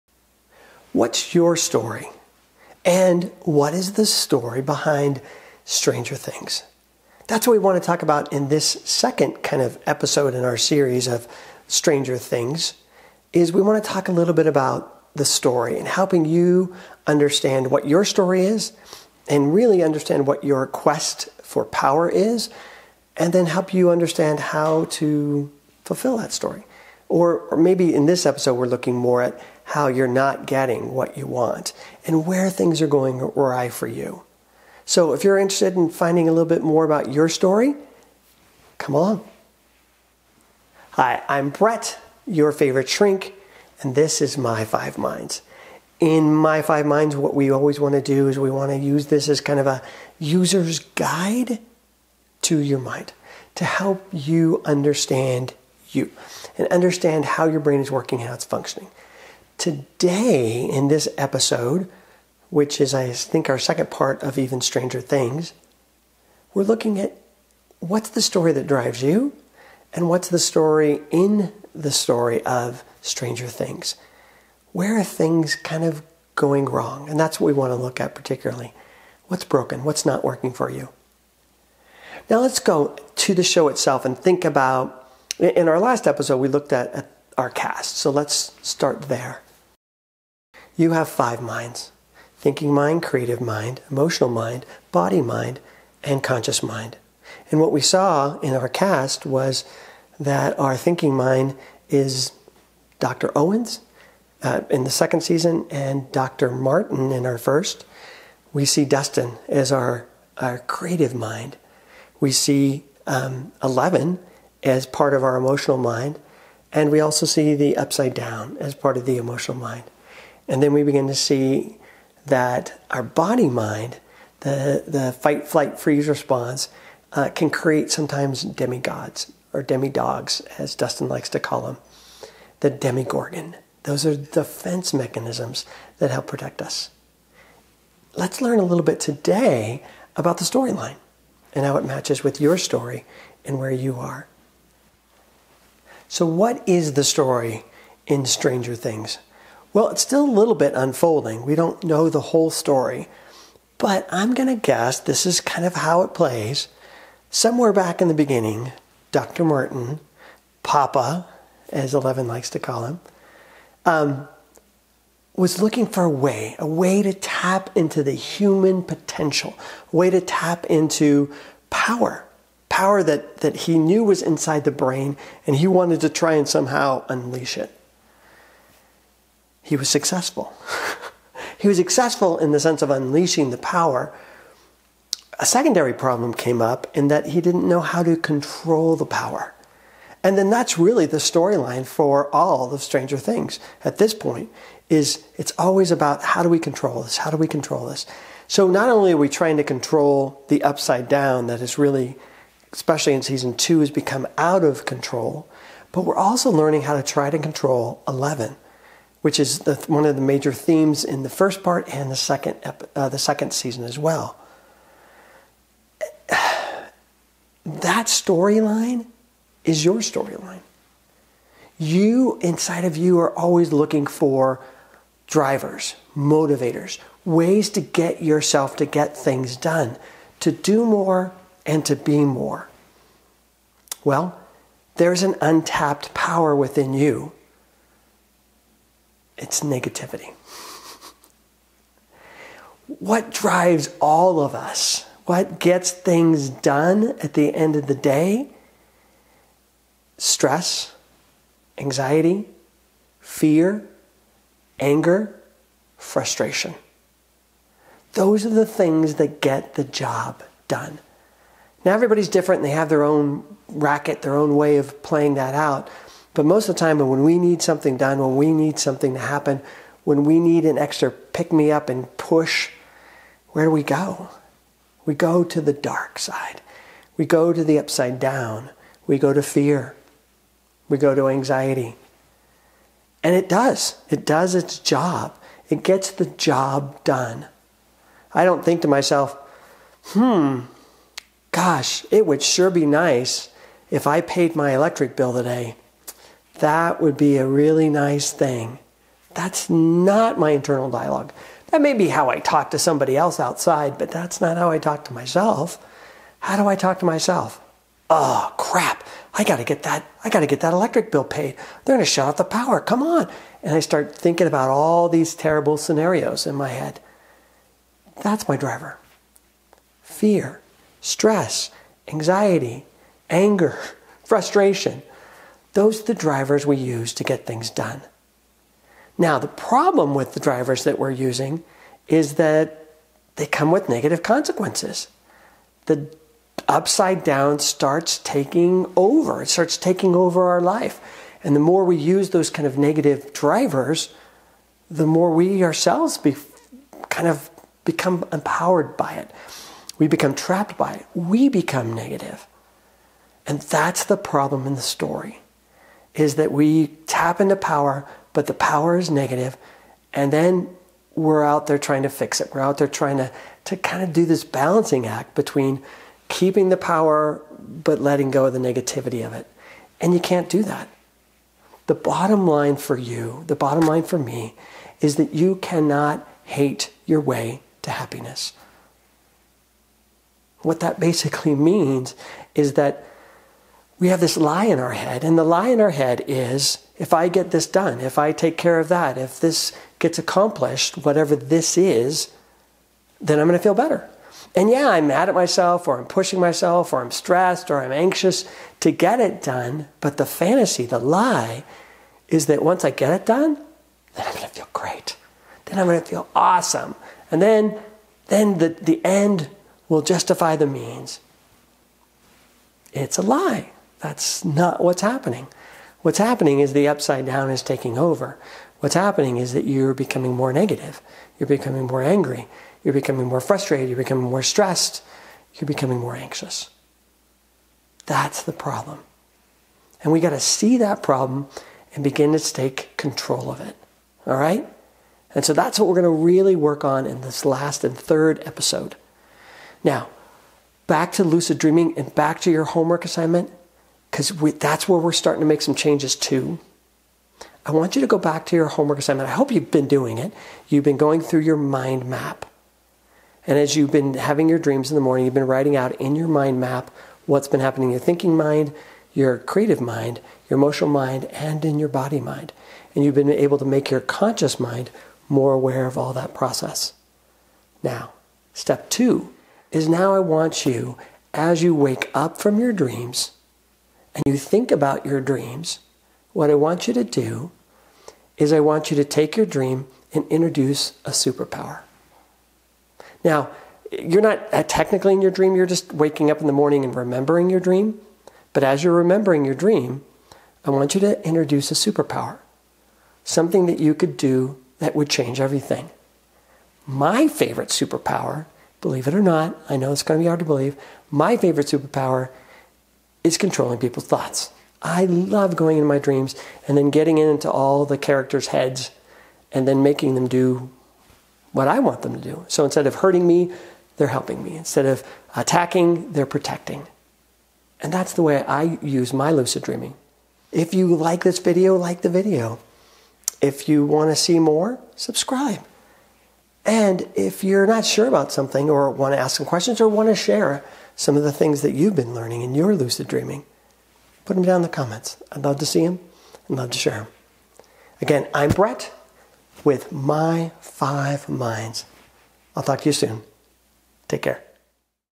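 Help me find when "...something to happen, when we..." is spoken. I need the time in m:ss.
4:28.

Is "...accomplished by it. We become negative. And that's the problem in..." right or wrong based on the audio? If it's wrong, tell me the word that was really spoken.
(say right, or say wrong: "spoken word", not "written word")
wrong: "trapped", not "accomplished".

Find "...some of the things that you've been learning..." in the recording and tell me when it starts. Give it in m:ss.
8:50.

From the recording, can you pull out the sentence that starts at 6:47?
And then, then the, the end will justify the means.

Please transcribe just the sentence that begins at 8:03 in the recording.
Now, you're not uh, technically in your dream, you're just waking up in the morning and remembering your dream.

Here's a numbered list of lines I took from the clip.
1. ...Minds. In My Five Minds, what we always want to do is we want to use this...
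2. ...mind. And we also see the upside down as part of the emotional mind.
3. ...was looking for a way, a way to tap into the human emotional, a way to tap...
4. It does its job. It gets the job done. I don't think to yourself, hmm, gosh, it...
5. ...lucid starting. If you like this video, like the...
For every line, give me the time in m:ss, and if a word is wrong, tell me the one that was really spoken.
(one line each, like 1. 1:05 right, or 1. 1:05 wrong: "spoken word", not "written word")
1. 0:44 right
2. 1:55 right
3. 2:45 wrong: "potential", not "emotional"
4. 4:44 wrong: "myself", not "yourself"
5. 8:39 wrong: "dreaming", not "starting".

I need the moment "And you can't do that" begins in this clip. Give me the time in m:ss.
6:09.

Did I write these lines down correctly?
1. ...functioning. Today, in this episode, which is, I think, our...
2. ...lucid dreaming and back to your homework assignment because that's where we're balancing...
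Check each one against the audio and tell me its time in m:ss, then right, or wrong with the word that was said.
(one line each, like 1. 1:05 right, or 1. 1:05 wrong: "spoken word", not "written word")
1. 0:58 right
2. 7:21 wrong: "starting", not "balancing".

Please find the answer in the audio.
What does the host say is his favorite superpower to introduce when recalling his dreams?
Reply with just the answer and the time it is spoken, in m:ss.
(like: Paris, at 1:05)
controlling people's thoughts, at 8:23.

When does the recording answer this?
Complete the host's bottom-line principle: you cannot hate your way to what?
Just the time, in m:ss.
6:17.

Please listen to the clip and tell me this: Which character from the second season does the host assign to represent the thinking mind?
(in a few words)
Dr. Owens.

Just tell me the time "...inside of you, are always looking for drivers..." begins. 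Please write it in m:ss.
3:42.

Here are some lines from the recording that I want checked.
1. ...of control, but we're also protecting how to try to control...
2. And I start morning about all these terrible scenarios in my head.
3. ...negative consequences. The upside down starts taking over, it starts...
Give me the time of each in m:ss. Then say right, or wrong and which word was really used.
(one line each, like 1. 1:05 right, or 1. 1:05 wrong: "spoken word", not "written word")
1. 3:24 wrong: "learning", not "protecting"
2. 5:13 wrong: "thinking", not "morning"
3. 5:33 right.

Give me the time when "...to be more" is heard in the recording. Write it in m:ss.
3:51.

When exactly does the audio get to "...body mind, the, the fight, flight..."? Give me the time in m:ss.
2:03.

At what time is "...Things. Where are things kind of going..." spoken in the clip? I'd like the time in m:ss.
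1:13.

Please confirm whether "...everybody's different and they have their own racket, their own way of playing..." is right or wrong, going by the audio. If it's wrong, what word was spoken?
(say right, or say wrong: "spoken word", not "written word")
right.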